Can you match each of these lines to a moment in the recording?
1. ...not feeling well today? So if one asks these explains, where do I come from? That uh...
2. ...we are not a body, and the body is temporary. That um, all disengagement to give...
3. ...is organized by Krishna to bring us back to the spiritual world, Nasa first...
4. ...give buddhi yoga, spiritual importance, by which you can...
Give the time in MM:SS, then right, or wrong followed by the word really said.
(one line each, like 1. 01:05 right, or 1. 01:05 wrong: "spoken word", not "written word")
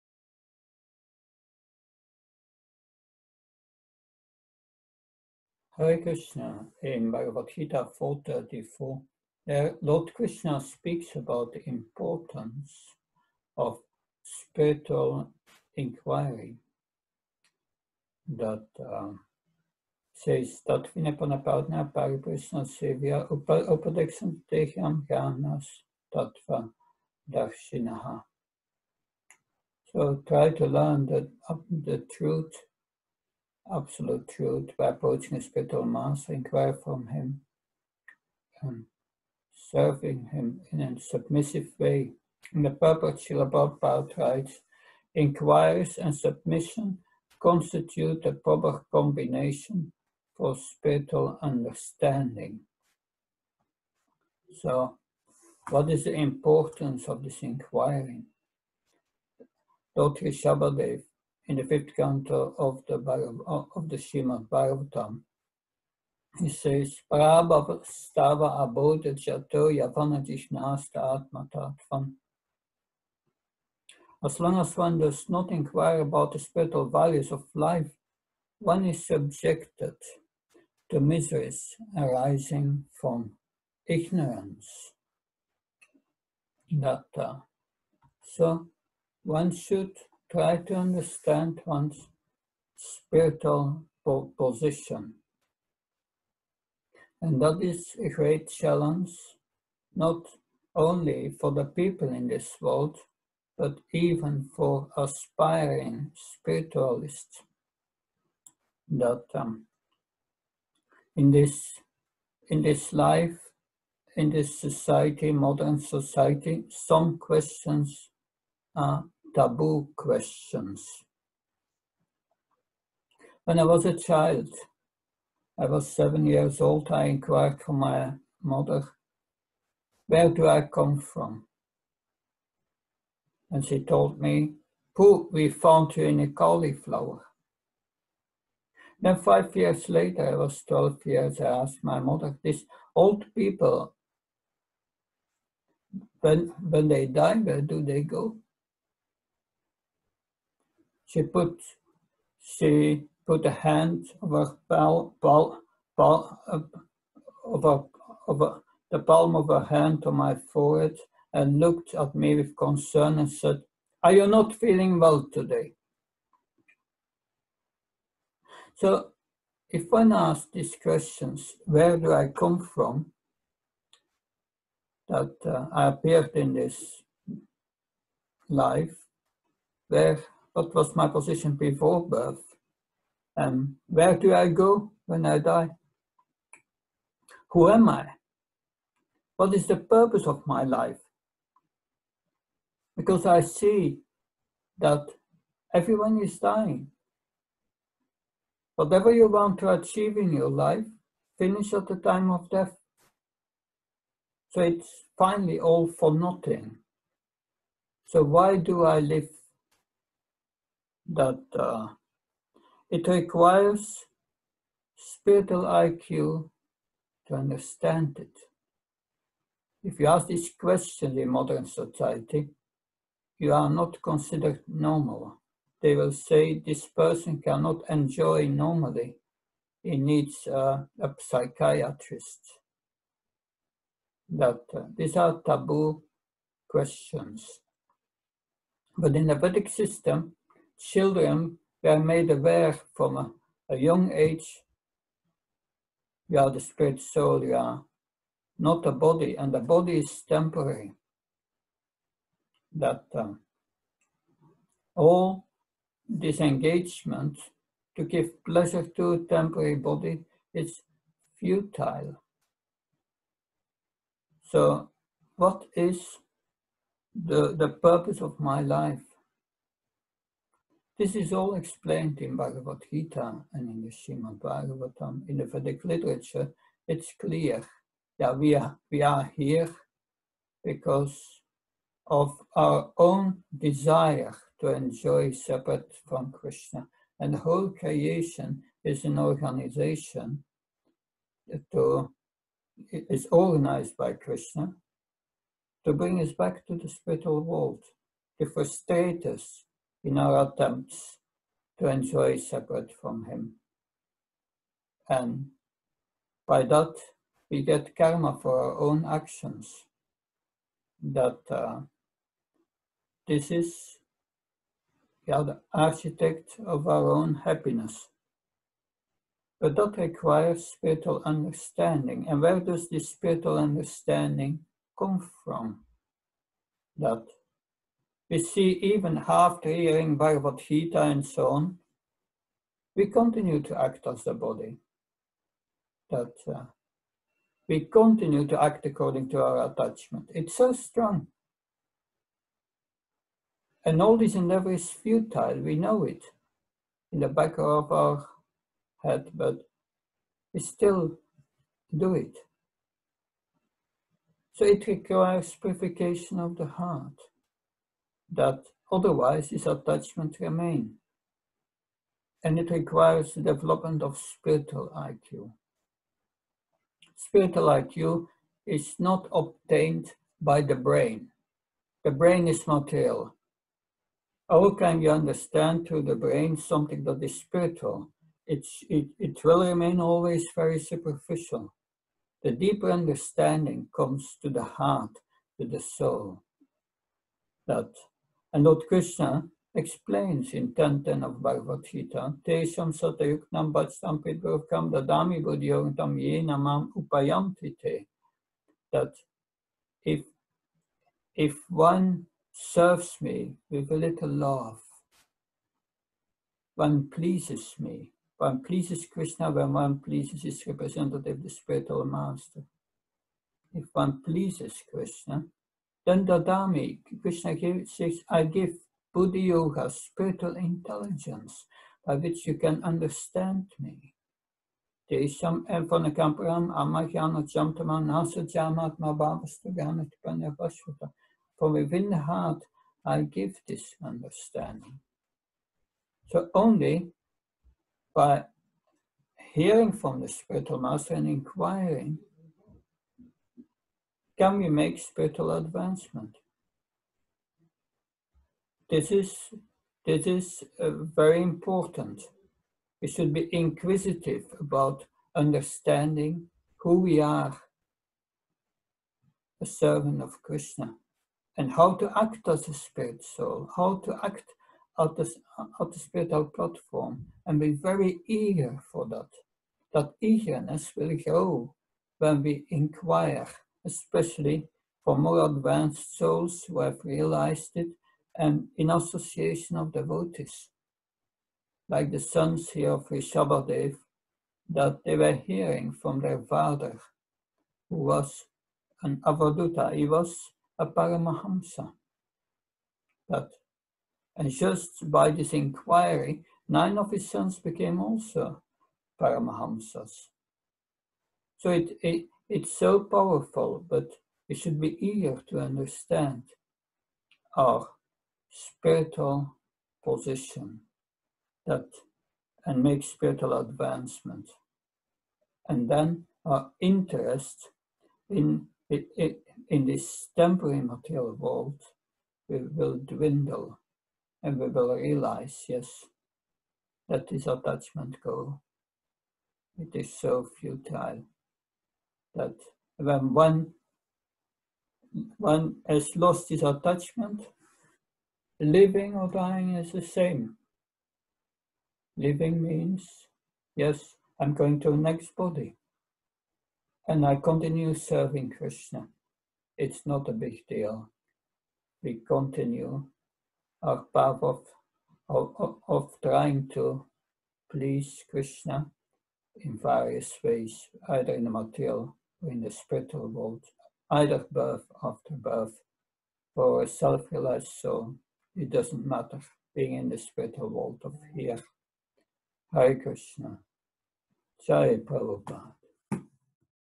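1. 02:44 wrong: "questions", not "explains"
2. 04:07 right
3. 04:52 wrong: "The", not "Nasa"
4. 06:58 wrong: "intelligence", not "importance".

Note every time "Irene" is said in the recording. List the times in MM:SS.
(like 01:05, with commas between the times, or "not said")
not said.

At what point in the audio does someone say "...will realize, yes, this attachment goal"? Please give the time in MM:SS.
08:44.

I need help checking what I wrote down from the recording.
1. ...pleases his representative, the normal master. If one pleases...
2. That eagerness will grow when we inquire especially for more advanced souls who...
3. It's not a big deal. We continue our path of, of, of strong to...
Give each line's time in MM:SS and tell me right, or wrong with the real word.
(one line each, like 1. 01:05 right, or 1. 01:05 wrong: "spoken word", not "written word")
1. 06:49 wrong: "spiritual", not "normal"
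2. 07:49 right
3. 09:09 wrong: "trying", not "strong".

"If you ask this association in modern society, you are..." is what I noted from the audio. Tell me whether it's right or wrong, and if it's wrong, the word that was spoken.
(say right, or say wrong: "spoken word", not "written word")
wrong: "question", not "association".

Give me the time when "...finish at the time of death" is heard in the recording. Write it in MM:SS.
03:21.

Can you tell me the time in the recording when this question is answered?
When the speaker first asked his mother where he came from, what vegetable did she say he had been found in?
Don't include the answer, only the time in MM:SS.
02:16.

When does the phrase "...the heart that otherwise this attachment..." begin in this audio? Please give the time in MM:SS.
05:56.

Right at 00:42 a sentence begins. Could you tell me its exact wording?
In the purport, Srila Prabhupada writes, inquiries and submission constitute the proper combination for spiritual understanding.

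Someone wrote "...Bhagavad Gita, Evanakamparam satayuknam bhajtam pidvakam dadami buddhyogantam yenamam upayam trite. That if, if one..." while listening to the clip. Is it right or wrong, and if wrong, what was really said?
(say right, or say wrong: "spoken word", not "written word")
wrong: "Tesham", not "Evanakamparam".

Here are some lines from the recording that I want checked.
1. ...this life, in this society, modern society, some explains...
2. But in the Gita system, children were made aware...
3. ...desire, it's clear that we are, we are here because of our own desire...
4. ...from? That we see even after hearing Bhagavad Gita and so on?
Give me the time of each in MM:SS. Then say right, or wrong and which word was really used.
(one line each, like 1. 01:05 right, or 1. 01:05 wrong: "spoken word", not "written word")
1. 01:52 wrong: "questions", not "explains"
2. 03:58 wrong: "Vedic", not "Gita"
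3. 04:35 wrong: "literature", not "desire"
4. 05:25 right.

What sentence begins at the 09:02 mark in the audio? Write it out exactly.
Living means, yes, I'm going to the next body.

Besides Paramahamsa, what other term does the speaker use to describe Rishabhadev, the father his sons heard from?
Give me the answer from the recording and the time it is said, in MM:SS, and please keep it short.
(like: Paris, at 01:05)
Avaduta, at 08:09.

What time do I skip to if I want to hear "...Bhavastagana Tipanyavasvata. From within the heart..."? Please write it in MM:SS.
07:09.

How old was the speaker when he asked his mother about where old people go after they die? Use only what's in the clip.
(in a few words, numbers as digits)
12.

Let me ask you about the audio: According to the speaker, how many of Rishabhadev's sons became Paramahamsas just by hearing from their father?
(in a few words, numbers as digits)
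Nine.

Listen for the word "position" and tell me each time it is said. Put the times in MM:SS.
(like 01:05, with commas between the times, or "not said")
01:34, 03:01, 08:30.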